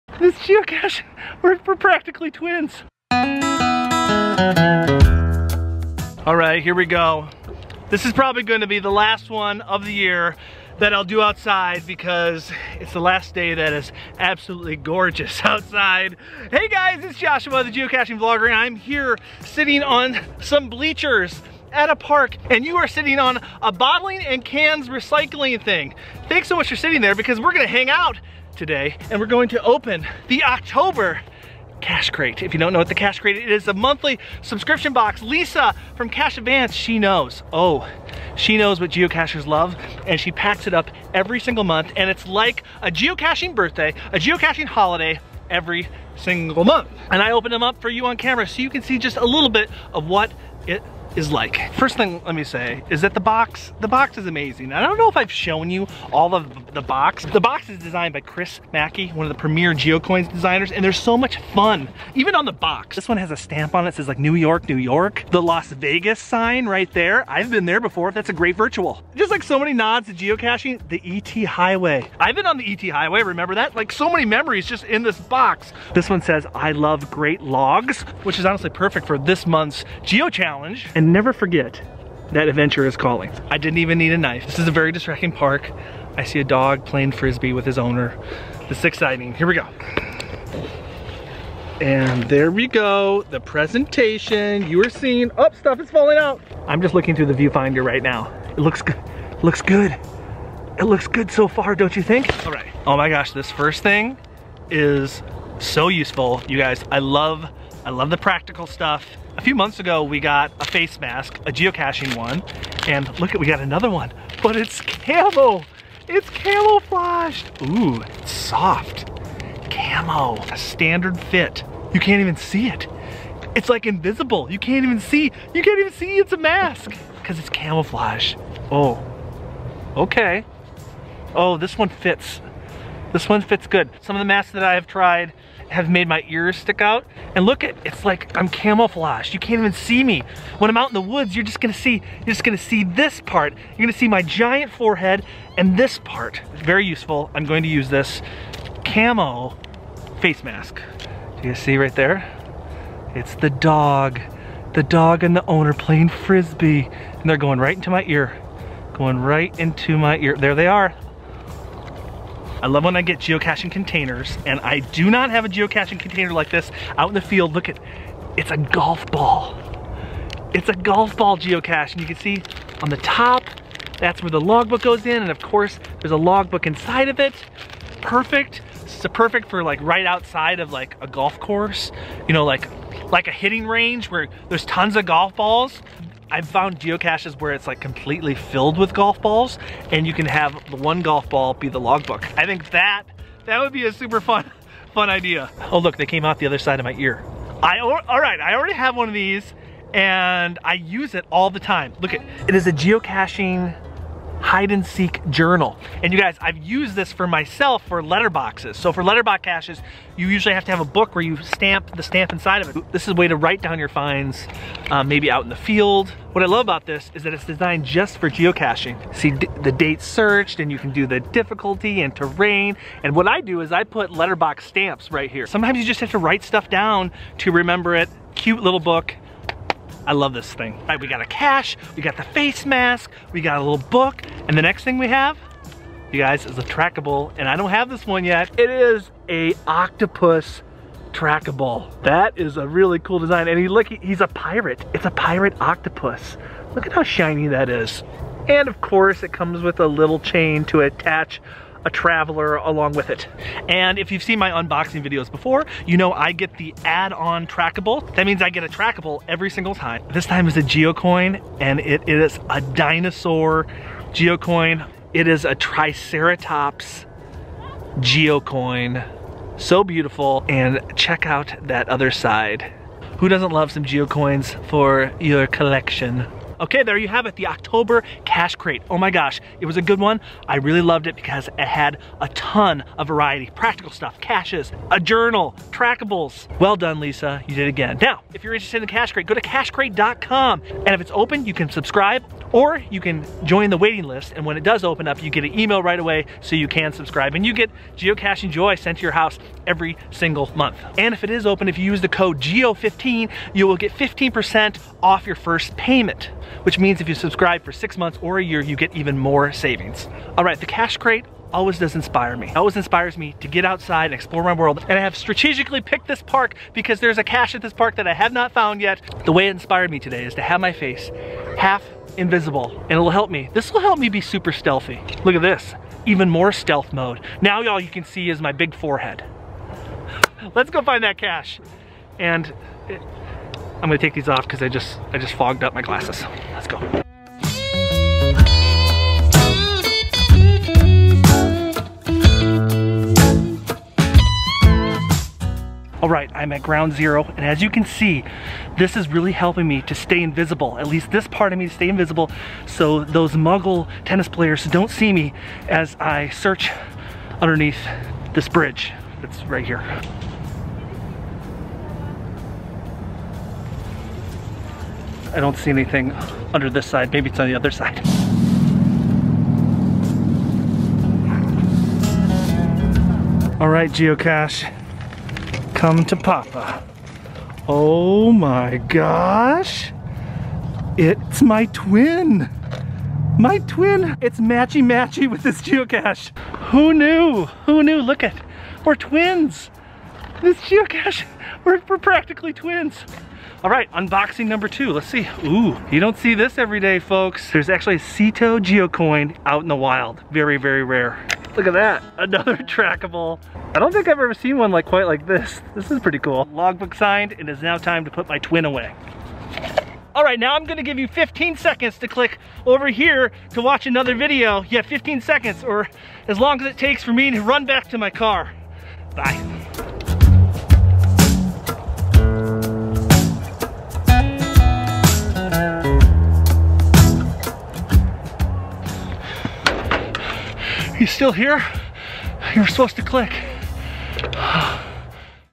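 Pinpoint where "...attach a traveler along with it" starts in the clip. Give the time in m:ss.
4:10.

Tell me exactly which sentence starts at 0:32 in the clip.
If you don't know what the Cache Crate is, it is a monthly subscription box.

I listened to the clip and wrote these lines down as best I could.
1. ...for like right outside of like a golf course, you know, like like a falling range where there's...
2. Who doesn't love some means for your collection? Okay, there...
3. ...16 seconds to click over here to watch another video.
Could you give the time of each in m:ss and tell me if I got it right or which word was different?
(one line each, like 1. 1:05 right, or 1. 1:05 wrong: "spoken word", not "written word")
1. 2:59 wrong: "hitting", not "falling"
2. 4:33 wrong: "geocoins", not "means"
3. 6:51 wrong: "15", not "16".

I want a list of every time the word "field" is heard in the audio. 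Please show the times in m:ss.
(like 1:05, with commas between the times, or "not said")
2:47, 3:35.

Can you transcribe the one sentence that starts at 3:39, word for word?
See the date searched and you can do the difficulty and terrain.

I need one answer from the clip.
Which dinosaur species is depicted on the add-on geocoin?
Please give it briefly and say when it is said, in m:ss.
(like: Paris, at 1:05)
Triceratops, at 4:25.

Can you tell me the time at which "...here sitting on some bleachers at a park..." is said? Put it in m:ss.
0:18.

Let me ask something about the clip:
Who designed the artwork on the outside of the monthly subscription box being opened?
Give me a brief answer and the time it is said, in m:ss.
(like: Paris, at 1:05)
Chris Mackey, at 0:58.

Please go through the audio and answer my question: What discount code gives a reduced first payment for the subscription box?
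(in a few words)
GEO15.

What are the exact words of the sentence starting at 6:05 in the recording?
I don't see anything under this side.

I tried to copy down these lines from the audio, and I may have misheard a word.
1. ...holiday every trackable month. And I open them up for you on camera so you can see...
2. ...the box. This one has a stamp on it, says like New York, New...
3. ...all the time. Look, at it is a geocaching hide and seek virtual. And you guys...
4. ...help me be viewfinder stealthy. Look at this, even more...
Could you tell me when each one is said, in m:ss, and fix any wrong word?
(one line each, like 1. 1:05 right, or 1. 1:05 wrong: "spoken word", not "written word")
1. 0:44 wrong: "single", not "trackable"
2. 1:02 right
3. 3:21 wrong: "journal", not "virtual"
4. 5:23 wrong: "super", not "viewfinder".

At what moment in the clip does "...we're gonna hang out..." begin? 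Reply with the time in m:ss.
0:27.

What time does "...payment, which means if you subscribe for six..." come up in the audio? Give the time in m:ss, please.
5:05.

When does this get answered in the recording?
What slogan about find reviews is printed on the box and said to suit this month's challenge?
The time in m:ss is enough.
1:16.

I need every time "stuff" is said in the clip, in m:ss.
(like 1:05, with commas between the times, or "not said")
1:35, 1:48, 3:46, 4:43.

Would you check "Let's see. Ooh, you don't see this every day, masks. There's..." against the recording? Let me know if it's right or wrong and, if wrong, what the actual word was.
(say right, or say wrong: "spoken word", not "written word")
wrong: "folks", not "masks".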